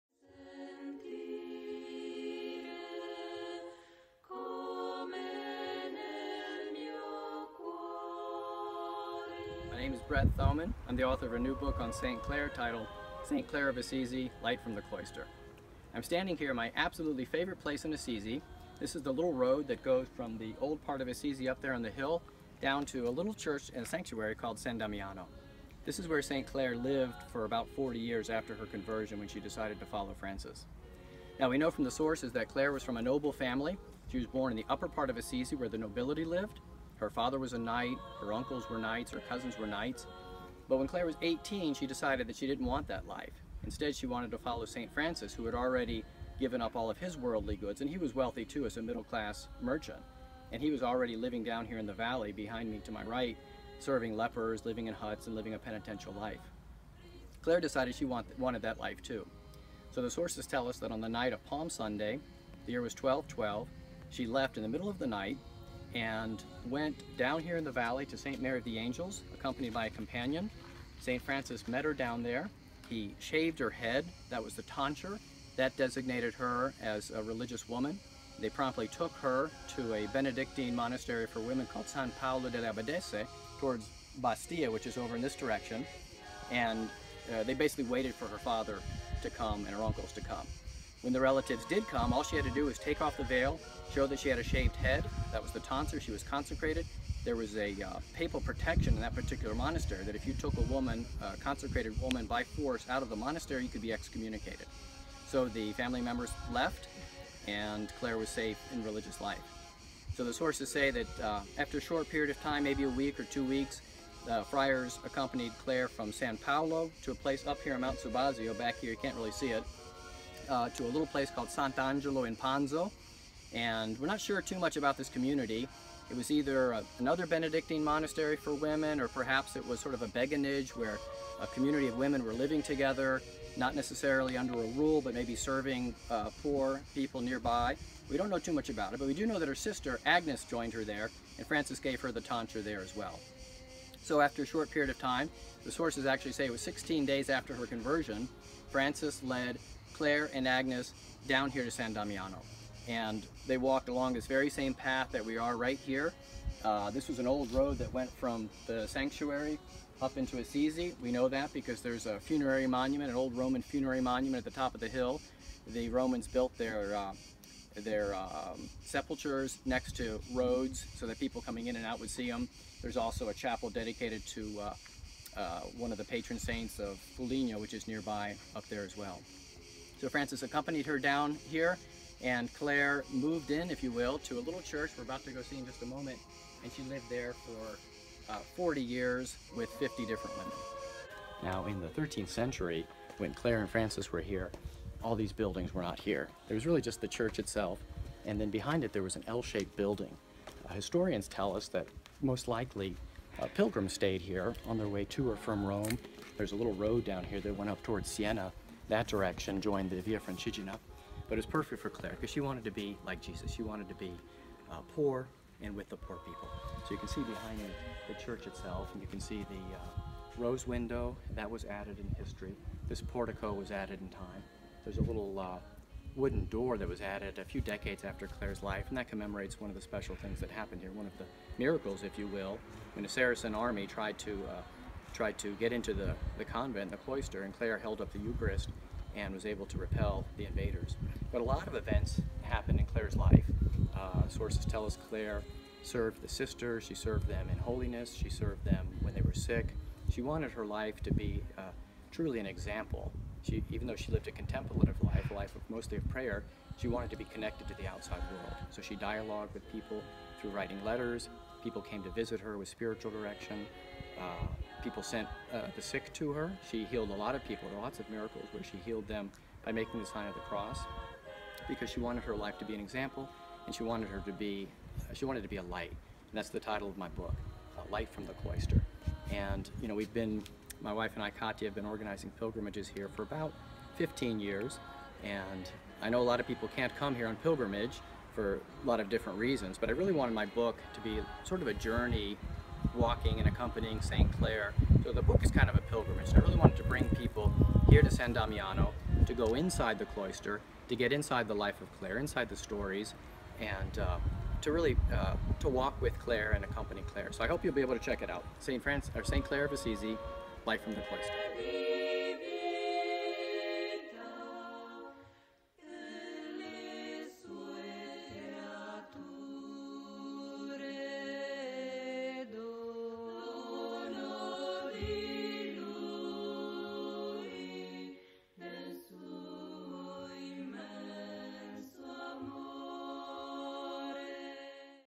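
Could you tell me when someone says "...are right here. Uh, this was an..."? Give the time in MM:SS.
02:35.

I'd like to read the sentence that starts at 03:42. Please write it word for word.
This portico was added in time.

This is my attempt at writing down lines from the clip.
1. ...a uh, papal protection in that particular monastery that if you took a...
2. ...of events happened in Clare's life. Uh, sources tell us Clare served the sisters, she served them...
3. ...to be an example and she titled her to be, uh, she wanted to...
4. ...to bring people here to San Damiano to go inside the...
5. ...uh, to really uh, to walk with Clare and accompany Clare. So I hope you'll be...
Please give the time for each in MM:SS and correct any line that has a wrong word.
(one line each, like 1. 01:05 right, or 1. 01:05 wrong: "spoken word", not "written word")
1. 01:37 right
2. 04:01 right
3. 04:32 wrong: "wanted", not "titled"
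4. 04:56 right
5. 05:03 right.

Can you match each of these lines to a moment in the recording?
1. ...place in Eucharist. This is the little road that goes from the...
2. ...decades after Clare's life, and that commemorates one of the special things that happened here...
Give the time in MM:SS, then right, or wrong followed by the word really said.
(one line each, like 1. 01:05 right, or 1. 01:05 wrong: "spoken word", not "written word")
1. 00:17 wrong: "Assisi", not "Eucharist"
2. 03:47 right.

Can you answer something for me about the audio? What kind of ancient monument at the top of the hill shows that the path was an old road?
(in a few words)
Roman funerary monument.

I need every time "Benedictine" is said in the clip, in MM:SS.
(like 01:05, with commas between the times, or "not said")
01:20, 02:07.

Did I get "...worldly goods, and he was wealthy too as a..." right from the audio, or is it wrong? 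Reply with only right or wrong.
right.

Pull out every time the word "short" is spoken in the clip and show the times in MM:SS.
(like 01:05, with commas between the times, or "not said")
01:51, 02:24.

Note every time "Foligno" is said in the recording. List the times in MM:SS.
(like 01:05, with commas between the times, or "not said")
02:57.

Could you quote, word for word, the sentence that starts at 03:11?
Now, in the 13th century, when Clare and Francis were here, all these buildings were not here.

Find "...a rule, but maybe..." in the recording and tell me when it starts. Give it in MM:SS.
02:14.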